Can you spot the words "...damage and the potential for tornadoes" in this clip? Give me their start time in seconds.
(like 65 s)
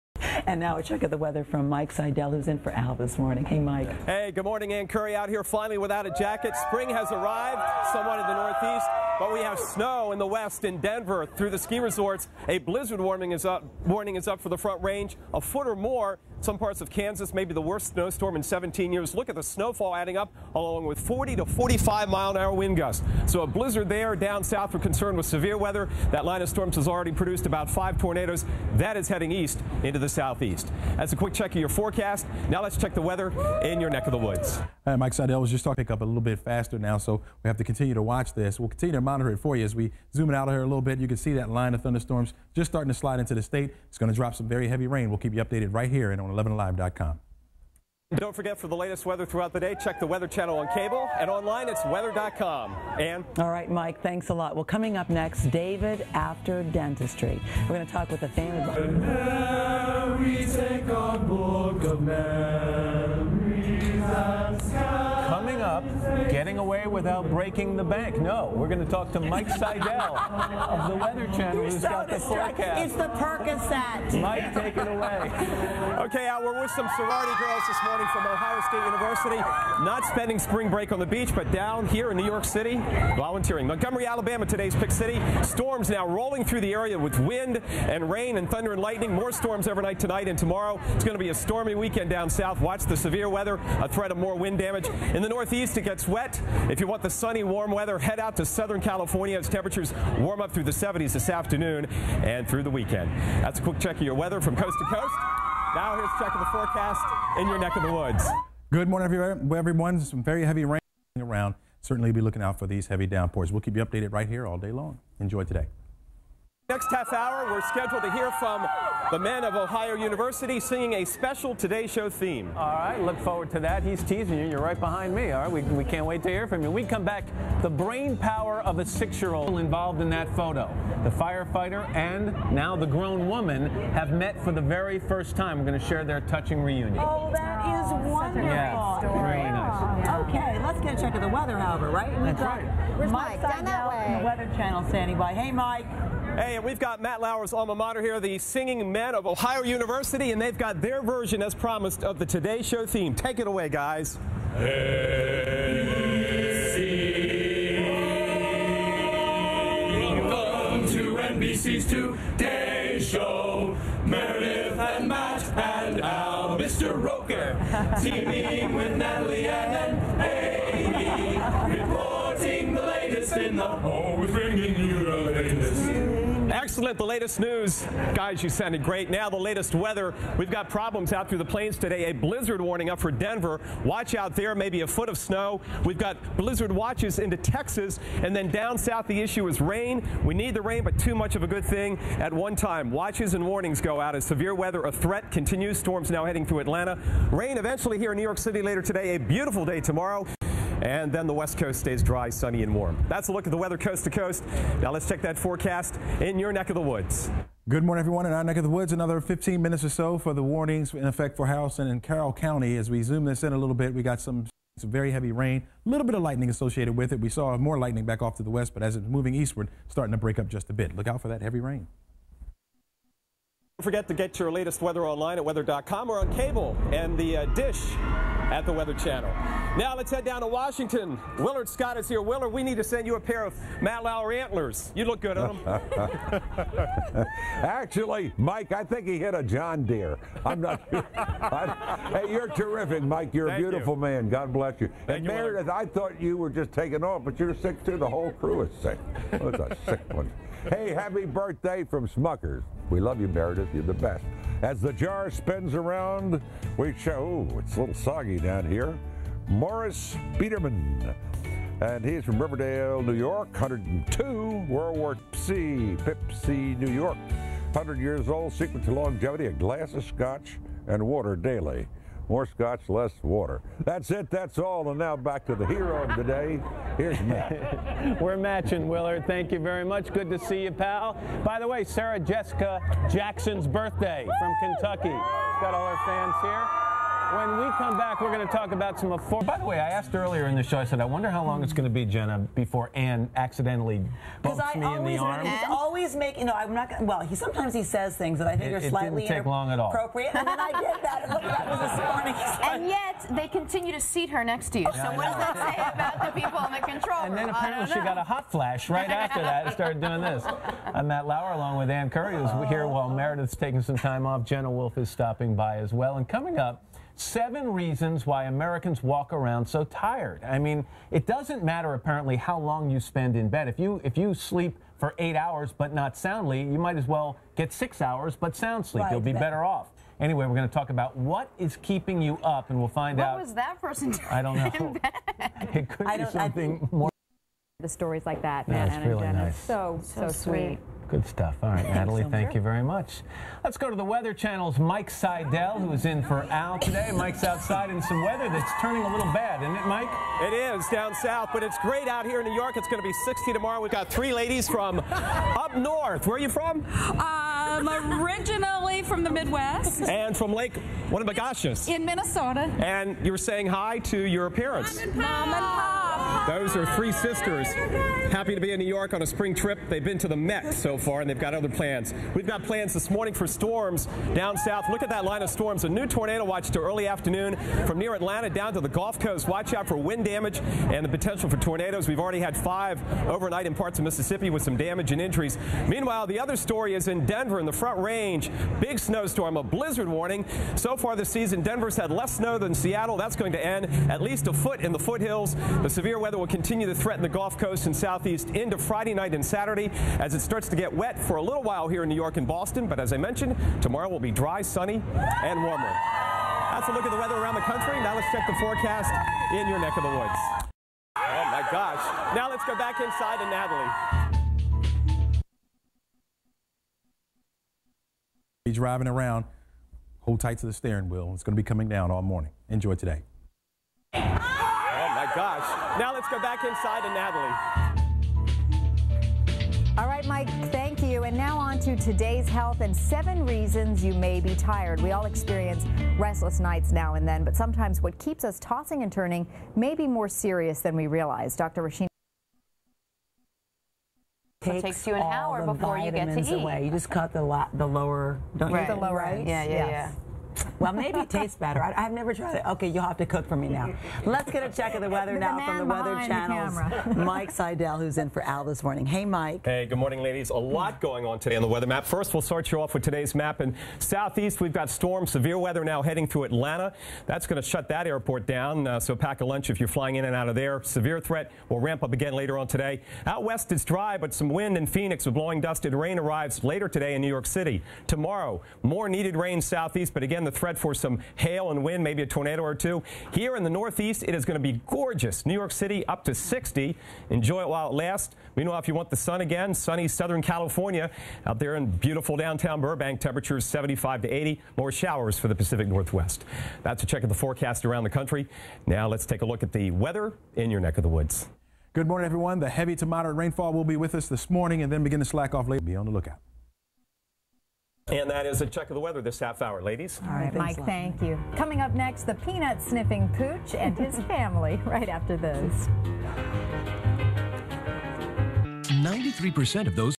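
380 s.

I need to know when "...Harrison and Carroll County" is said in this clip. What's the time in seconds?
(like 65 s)
211 s.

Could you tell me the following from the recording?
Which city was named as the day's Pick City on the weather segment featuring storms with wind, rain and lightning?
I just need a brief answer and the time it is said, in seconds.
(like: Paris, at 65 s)
Montgomery, Alabama, at 83 s.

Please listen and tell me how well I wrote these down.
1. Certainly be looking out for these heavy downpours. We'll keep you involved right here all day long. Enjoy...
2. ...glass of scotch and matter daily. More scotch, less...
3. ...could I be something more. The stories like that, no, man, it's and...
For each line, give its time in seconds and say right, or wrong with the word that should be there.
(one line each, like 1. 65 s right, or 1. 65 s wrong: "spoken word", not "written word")
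1. 111 s wrong: "updated", not "involved"
2. 269 s wrong: "water", not "matter"
3. 335 s right.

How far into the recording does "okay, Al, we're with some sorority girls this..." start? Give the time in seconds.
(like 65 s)
76 s.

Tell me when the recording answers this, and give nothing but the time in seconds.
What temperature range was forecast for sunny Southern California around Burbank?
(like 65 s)
493 s.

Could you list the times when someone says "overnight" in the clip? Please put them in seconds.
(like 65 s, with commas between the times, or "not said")
89 s, 383 s.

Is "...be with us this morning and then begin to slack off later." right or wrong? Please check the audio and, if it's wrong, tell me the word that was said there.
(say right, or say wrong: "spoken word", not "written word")
right.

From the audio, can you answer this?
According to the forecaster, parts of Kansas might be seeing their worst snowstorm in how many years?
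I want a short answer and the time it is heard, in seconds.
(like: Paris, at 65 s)
17, at 18 s.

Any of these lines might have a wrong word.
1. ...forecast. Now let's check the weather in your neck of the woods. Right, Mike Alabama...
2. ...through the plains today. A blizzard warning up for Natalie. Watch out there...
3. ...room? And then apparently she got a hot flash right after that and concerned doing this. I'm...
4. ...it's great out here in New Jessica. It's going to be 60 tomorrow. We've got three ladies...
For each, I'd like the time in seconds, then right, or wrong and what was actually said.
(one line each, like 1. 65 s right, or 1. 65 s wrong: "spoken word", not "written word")
1. 31 s wrong: "Seidel", not "Alabama"
2. 181 s wrong: "Denver", not "Natalie"
3. 307 s wrong: "started", not "concerned"
4. 351 s wrong: "York", not "Jessica".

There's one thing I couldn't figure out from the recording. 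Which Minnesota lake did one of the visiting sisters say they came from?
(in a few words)
Lake Winnibigoshish.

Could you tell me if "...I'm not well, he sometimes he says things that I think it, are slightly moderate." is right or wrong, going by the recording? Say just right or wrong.
wrong.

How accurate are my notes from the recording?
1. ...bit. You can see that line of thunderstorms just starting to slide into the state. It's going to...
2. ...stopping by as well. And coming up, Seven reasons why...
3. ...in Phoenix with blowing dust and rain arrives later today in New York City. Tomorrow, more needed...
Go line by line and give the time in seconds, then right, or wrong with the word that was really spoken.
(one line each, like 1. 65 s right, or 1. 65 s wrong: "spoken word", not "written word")
1. 40 s right
2. 315 s right
3. 474 s right.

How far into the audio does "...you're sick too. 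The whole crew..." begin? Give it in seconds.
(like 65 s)
247 s.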